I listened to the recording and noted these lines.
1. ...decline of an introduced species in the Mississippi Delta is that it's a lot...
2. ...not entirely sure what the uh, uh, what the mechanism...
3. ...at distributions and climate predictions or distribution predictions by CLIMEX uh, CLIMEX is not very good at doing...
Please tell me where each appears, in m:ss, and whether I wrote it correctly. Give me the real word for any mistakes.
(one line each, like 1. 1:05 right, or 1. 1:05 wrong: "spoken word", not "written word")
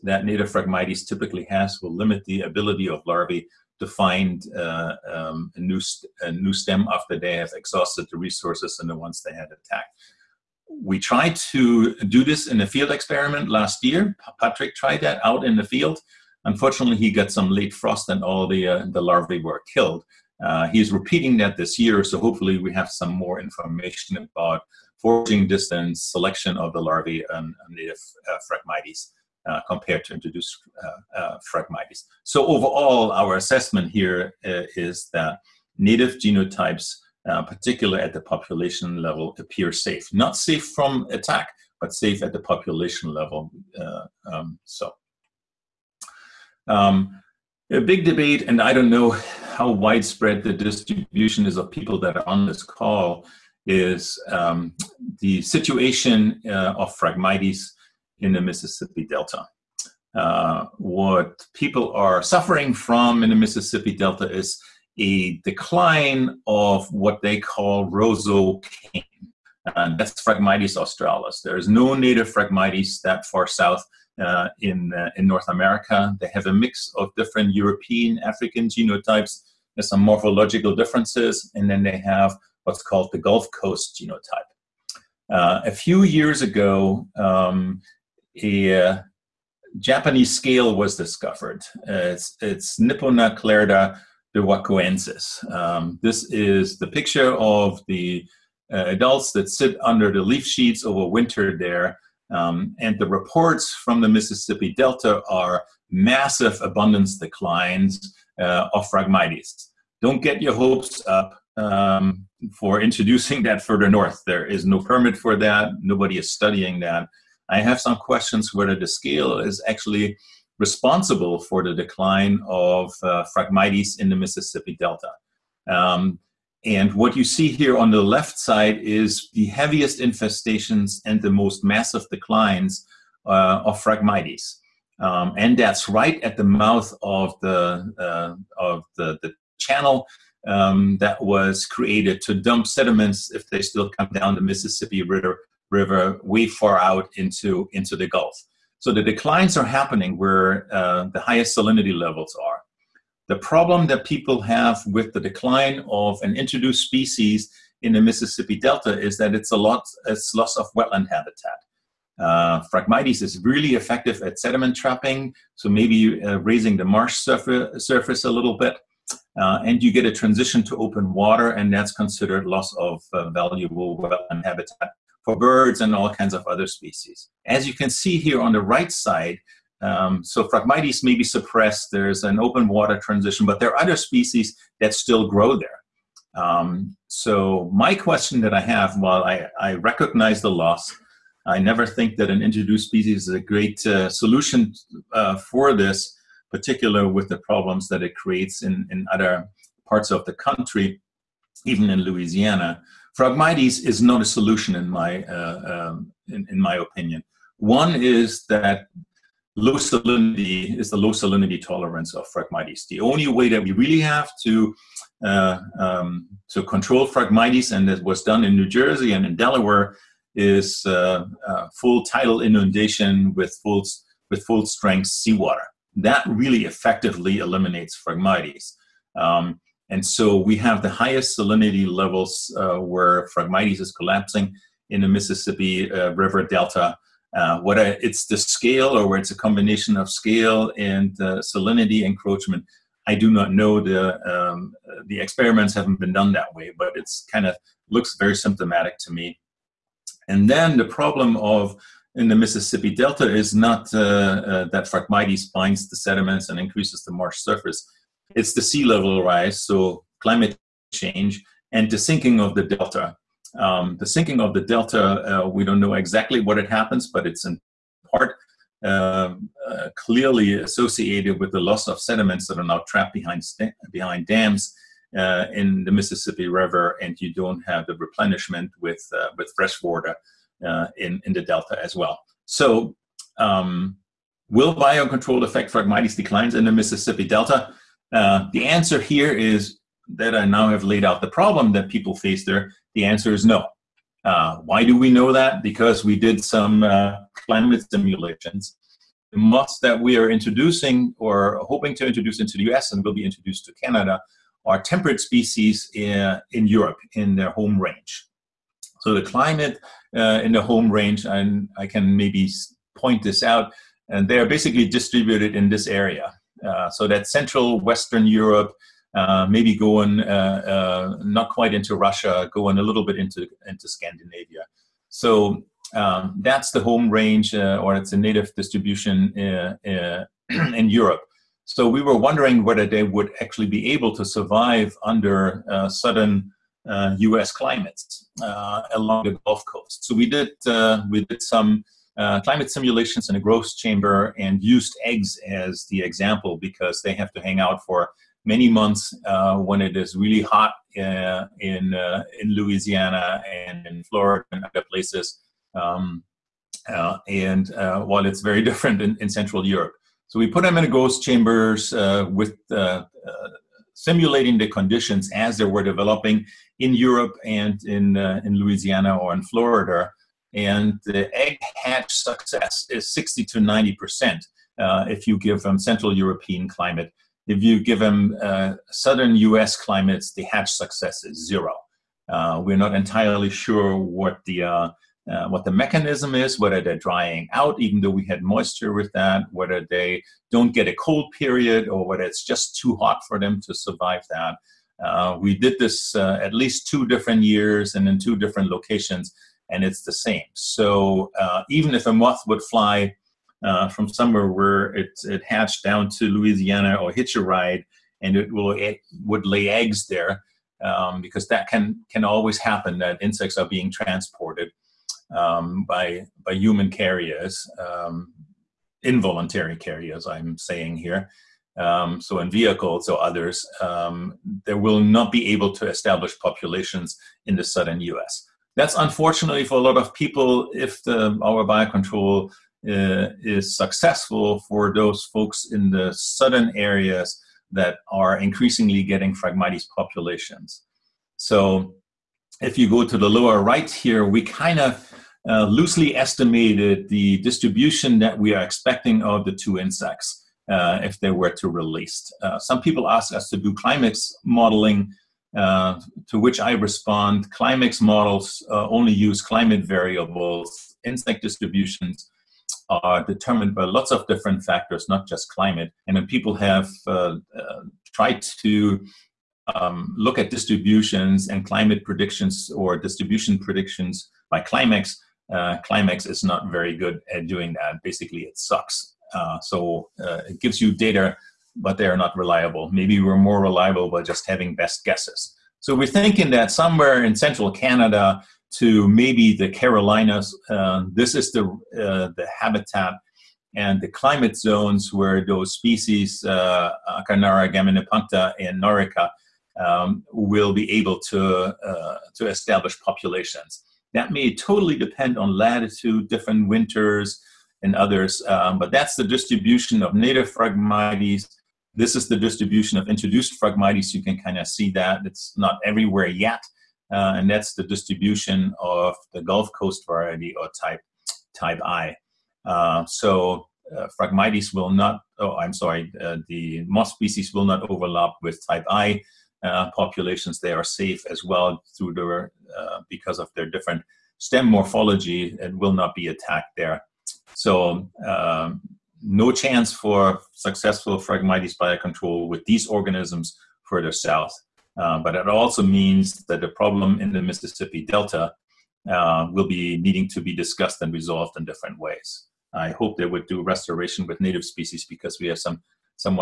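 1. 2:35 right
2. 6:22 right
3. 7:50 right.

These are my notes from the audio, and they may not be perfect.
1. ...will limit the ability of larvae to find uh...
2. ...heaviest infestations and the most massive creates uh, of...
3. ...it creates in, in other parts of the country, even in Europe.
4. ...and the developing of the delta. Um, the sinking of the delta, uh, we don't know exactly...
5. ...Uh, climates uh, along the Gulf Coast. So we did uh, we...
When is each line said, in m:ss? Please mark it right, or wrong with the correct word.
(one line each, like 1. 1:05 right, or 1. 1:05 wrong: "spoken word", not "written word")
1. 0:01 right
2. 2:09 wrong: "declines", not "creates"
3. 3:18 wrong: "Louisiana", not "Europe"
4. 4:21 wrong: "sinking", not "developing"
5. 5:37 right.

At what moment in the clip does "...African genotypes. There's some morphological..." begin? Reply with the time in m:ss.
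1:18.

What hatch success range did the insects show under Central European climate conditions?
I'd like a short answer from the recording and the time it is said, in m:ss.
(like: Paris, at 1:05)
60 to 90 percent, at 6:13.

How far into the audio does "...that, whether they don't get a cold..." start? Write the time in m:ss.
6:29.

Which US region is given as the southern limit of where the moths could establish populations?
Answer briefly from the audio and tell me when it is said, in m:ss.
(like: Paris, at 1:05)
The Carolinas, at 8:09.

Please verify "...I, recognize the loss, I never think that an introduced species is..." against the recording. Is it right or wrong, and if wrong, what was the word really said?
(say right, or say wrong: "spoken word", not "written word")
right.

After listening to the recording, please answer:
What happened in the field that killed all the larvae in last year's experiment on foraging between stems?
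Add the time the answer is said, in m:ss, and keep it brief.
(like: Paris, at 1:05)
Late frost, at 0:17.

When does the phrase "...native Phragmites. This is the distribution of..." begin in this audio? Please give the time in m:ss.
8:30.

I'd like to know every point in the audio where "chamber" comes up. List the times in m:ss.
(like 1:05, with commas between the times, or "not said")
5:43, 6:01.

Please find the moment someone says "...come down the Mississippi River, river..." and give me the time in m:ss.
2:23.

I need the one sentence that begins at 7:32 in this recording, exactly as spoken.
Uh, some people ask us to do CLIMEX modeling, uh, to which I respond CLIMEX models uh, only use climate variables.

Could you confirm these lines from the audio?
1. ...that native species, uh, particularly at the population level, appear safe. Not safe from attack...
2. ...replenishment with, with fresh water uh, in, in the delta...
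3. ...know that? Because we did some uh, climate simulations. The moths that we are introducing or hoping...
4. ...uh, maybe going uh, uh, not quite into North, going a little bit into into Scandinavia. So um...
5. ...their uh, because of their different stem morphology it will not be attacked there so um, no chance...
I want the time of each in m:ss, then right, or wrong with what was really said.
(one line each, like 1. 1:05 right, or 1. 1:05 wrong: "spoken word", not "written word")
1. 0:35 wrong: "genotypes", not "species"
2. 4:37 right
3. 4:55 right
4. 5:19 wrong: "Russia", not "North"
5. 8:52 right.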